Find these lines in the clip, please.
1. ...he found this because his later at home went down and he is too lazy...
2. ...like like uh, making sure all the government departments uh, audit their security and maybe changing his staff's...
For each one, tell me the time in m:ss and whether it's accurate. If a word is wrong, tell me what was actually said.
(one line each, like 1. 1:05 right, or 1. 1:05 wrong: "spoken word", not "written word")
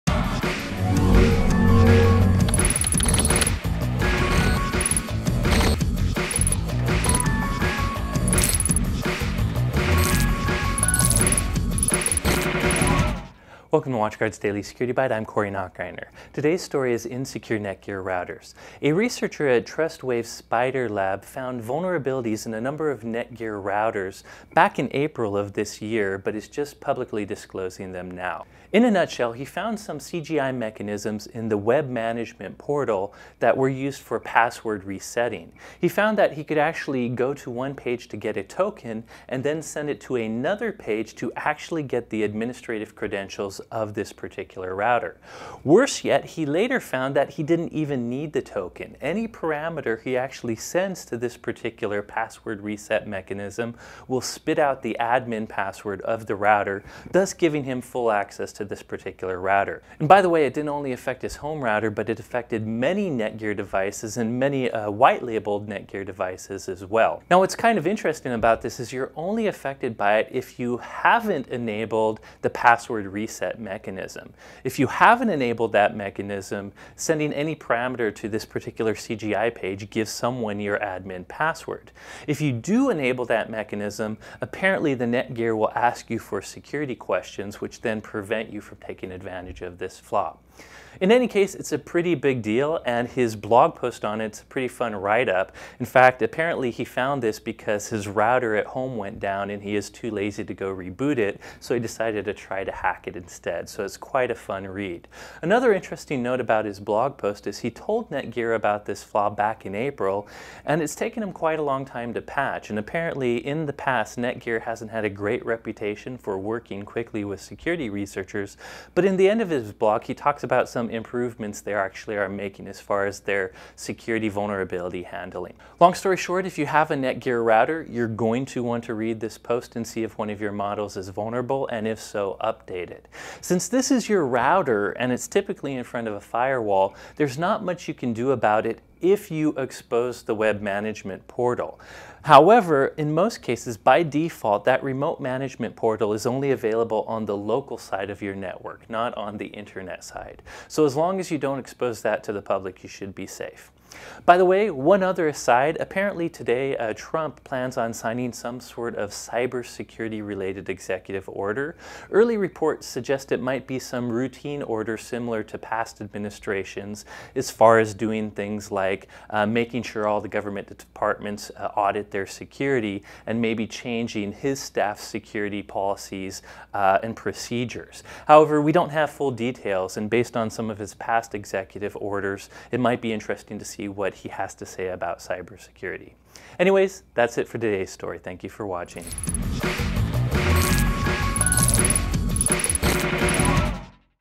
1. 1:36 wrong: "router", not "later"
2. 2:48 right.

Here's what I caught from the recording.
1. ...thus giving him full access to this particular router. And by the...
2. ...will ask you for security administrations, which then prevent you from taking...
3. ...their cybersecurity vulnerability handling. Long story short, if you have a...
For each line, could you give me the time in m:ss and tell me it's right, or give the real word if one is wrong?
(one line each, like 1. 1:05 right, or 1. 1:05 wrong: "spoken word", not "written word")
1. 0:57 right
2. 1:25 wrong: "questions", not "administrations"
3. 2:03 wrong: "security", not "cybersecurity".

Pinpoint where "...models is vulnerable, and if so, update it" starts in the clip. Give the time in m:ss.
2:10.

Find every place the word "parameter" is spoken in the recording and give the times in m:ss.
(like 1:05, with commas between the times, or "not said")
0:49, 1:17.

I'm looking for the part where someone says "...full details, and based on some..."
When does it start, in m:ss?
2:59.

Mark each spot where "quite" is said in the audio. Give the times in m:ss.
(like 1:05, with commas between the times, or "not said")
1:43, 1:51.